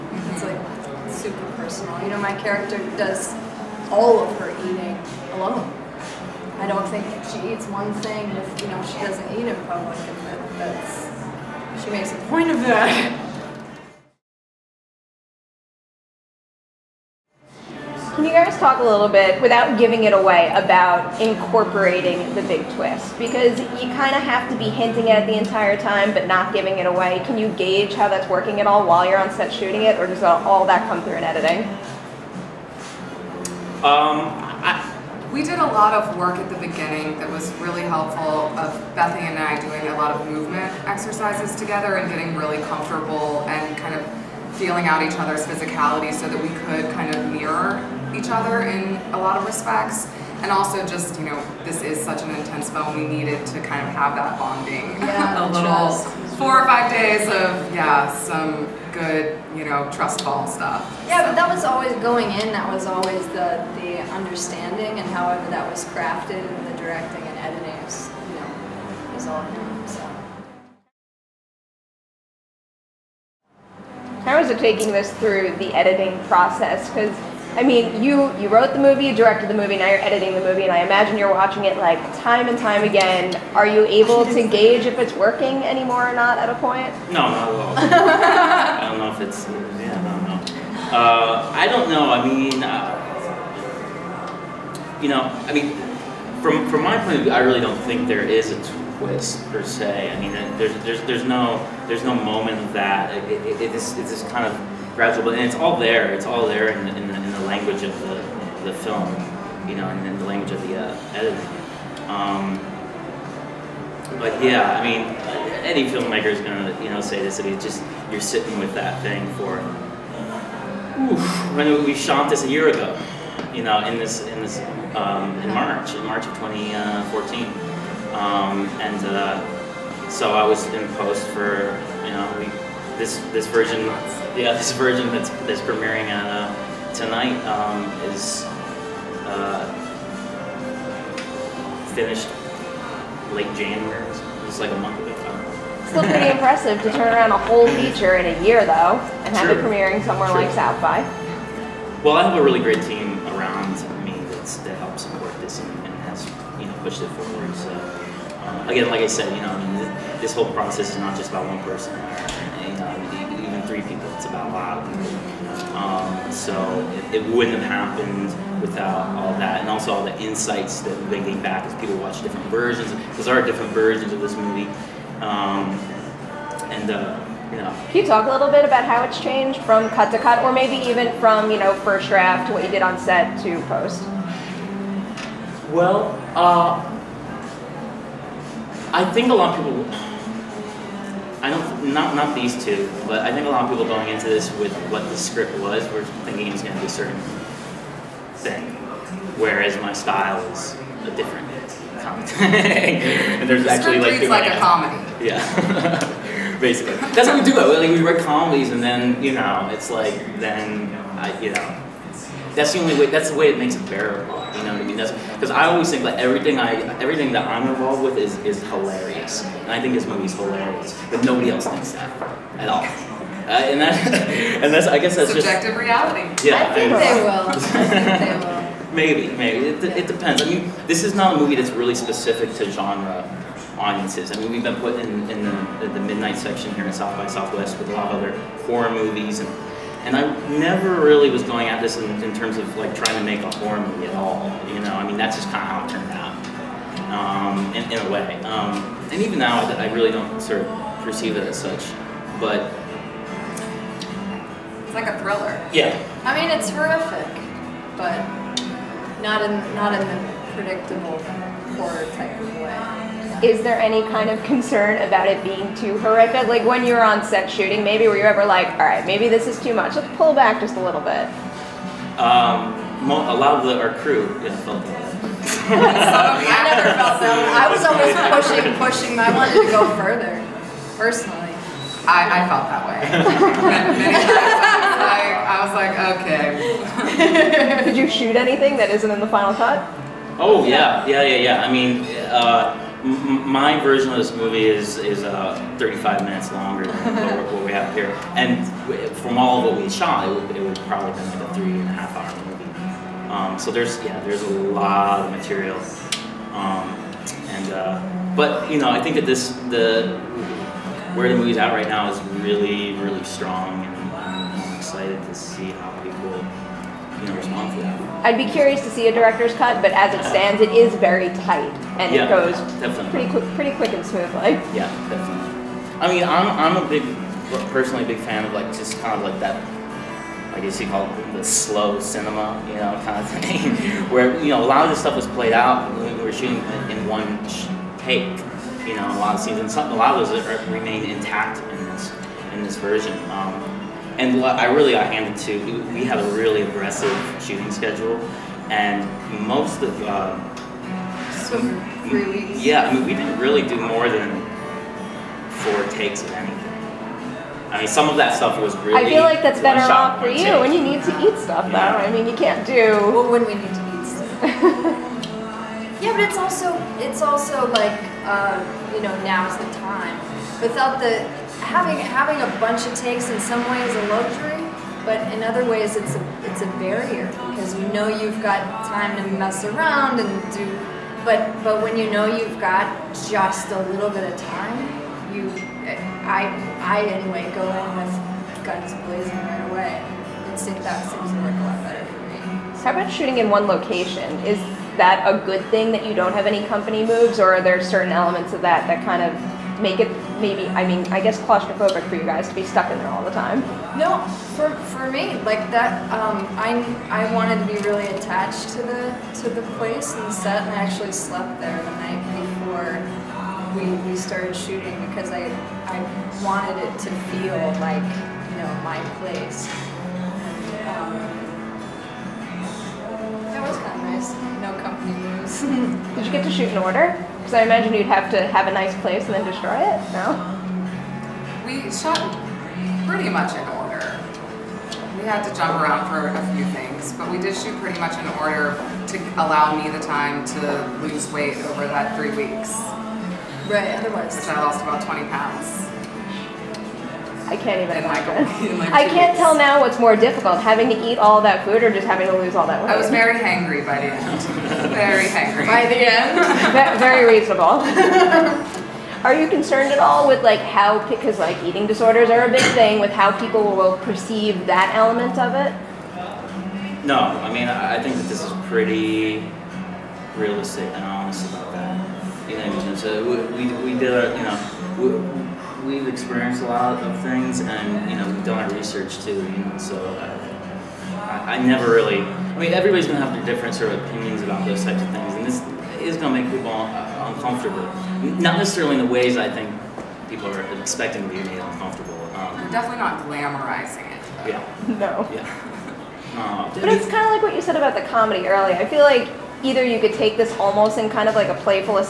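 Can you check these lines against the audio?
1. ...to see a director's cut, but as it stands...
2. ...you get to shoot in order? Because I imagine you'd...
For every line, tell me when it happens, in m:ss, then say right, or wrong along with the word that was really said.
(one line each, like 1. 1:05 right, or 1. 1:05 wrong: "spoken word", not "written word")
1. 5:18 right
2. 7:06 right.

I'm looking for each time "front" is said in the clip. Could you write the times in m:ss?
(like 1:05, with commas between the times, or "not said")
not said.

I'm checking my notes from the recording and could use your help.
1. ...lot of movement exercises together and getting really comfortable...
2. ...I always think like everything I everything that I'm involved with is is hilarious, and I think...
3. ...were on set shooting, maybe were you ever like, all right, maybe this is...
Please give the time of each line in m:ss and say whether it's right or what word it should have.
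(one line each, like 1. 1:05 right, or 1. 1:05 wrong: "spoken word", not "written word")
1. 0:39 right
2. 3:35 right
3. 4:26 right.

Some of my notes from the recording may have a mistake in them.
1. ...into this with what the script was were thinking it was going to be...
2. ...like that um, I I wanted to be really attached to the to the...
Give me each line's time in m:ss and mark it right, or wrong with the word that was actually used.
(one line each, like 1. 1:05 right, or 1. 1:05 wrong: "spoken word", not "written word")
1. 3:14 right
2. 6:45 right.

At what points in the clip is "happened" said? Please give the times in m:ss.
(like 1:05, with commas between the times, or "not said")
2:47.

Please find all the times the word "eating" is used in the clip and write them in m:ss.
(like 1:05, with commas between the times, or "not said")
0:04, 7:41.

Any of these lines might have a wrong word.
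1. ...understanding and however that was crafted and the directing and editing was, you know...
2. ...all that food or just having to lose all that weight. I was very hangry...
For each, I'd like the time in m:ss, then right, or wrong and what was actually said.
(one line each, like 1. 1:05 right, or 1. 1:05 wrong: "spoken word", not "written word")
1. 1:04 right
2. 7:31 right.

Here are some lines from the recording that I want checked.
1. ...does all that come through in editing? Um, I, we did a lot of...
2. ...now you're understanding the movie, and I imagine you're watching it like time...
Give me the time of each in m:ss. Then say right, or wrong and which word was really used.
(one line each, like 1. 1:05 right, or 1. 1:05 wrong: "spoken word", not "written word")
1. 0:30 right
2. 1:19 wrong: "editing", not "understanding".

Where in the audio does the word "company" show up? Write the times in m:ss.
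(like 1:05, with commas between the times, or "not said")
6:36, 7:04.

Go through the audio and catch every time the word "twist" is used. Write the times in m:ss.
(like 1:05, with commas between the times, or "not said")
0:22, 1:38.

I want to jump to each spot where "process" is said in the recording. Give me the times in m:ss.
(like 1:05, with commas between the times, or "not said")
1:16, 2:40.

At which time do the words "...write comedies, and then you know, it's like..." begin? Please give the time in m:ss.
3:28.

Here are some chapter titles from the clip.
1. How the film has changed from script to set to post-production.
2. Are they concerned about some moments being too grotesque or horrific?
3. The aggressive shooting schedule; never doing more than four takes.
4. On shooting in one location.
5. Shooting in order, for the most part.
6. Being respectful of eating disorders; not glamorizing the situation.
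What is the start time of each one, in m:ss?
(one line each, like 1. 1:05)
1. 2:55
2. 4:20
3. 5:23
4. 6:30
5. 7:05
6. 7:36.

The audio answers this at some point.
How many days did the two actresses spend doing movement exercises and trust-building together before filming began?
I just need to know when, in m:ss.
0:56.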